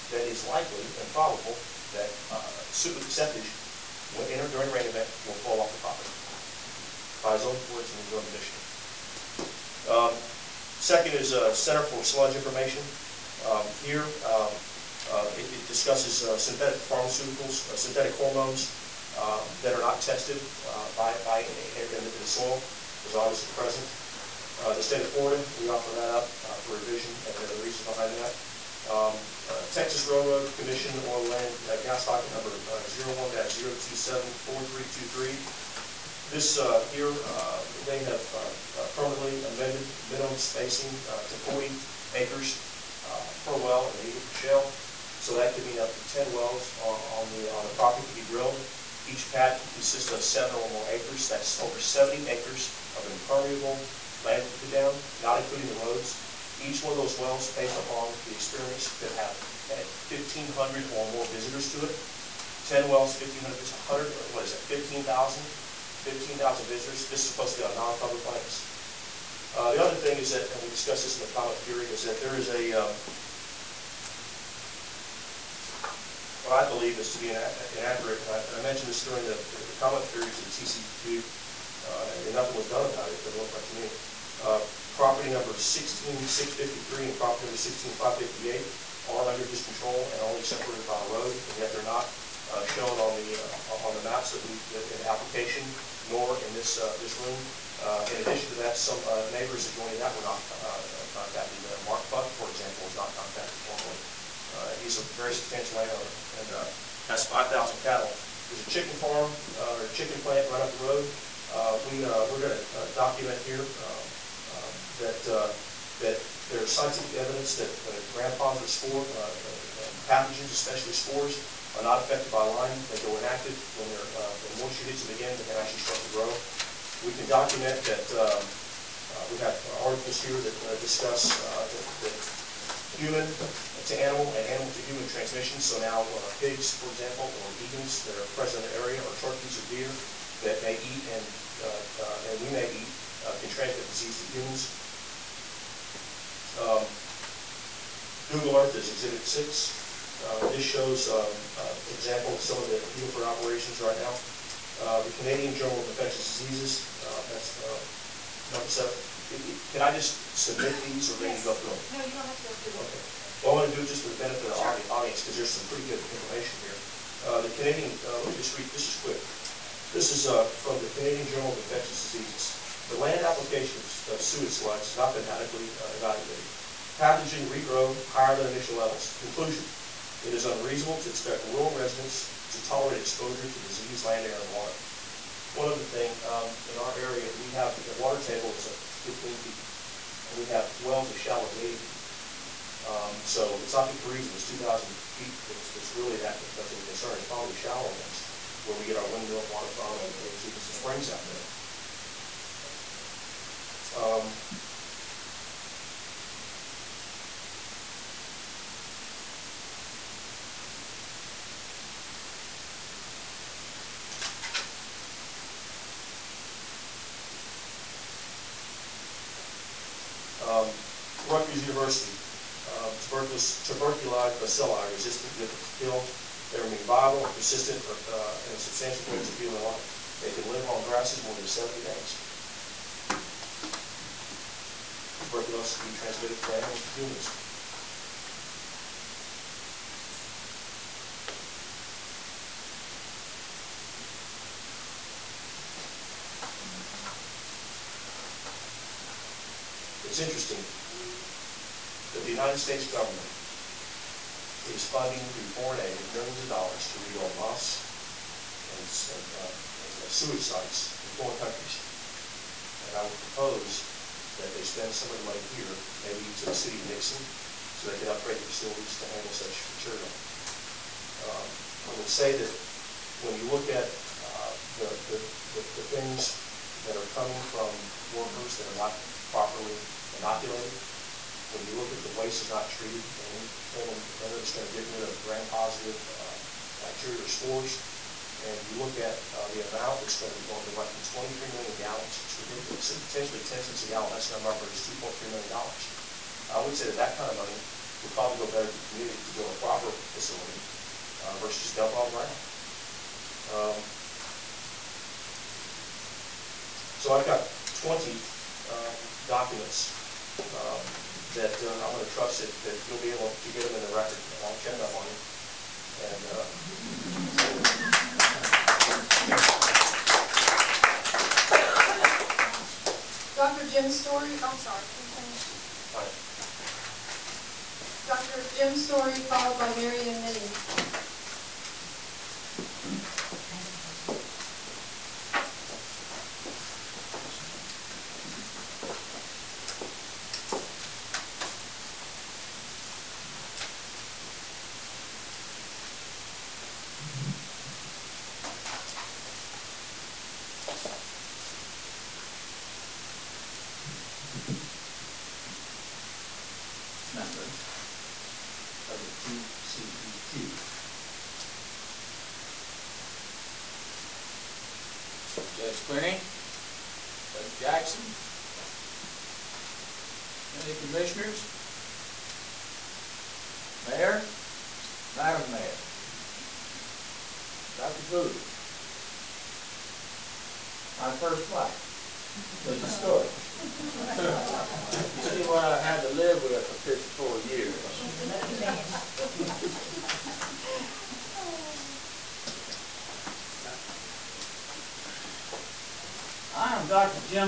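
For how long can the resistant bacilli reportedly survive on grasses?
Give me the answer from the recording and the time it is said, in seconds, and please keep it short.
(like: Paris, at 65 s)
more than 70 days, at 231 s.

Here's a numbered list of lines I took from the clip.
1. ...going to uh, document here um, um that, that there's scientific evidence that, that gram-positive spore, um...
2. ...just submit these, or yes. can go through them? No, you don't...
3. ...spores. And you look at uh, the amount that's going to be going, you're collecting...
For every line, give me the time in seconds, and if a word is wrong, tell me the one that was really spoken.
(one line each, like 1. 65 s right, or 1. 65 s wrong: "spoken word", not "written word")
1. 112 s right
2. 159 s right
3. 287 s right.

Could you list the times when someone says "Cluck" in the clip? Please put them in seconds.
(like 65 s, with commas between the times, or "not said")
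102 s.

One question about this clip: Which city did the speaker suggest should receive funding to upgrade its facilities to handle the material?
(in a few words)
Nixon.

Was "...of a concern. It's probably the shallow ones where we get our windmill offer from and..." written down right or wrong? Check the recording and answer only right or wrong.
wrong.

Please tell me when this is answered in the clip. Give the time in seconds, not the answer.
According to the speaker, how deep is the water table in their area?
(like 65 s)
188 s.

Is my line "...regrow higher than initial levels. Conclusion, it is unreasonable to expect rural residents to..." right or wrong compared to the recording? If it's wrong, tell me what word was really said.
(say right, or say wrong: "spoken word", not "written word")
right.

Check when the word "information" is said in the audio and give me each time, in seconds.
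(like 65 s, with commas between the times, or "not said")
12 s, 166 s.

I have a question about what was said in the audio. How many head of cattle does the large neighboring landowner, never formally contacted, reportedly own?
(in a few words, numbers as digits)
5,000.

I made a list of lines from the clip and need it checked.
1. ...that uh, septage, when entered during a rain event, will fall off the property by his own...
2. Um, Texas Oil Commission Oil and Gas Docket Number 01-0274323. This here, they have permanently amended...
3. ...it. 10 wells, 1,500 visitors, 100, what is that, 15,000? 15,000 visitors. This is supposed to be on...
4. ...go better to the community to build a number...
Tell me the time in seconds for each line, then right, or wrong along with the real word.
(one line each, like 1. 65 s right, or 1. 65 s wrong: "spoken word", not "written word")
1. 1 s right
2. 28 s wrong: "Railroad", not "Oil"
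3. 61 s right
4. 298 s wrong: "proper", not "number".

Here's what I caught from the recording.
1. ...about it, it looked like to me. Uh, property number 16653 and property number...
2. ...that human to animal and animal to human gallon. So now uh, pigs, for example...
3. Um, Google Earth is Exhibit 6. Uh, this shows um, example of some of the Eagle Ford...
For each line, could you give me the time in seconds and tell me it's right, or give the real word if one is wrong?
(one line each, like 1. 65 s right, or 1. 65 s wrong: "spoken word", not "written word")
1. 82 s right
2. 132 s wrong: "transmission", not "gallon"
3. 146 s right.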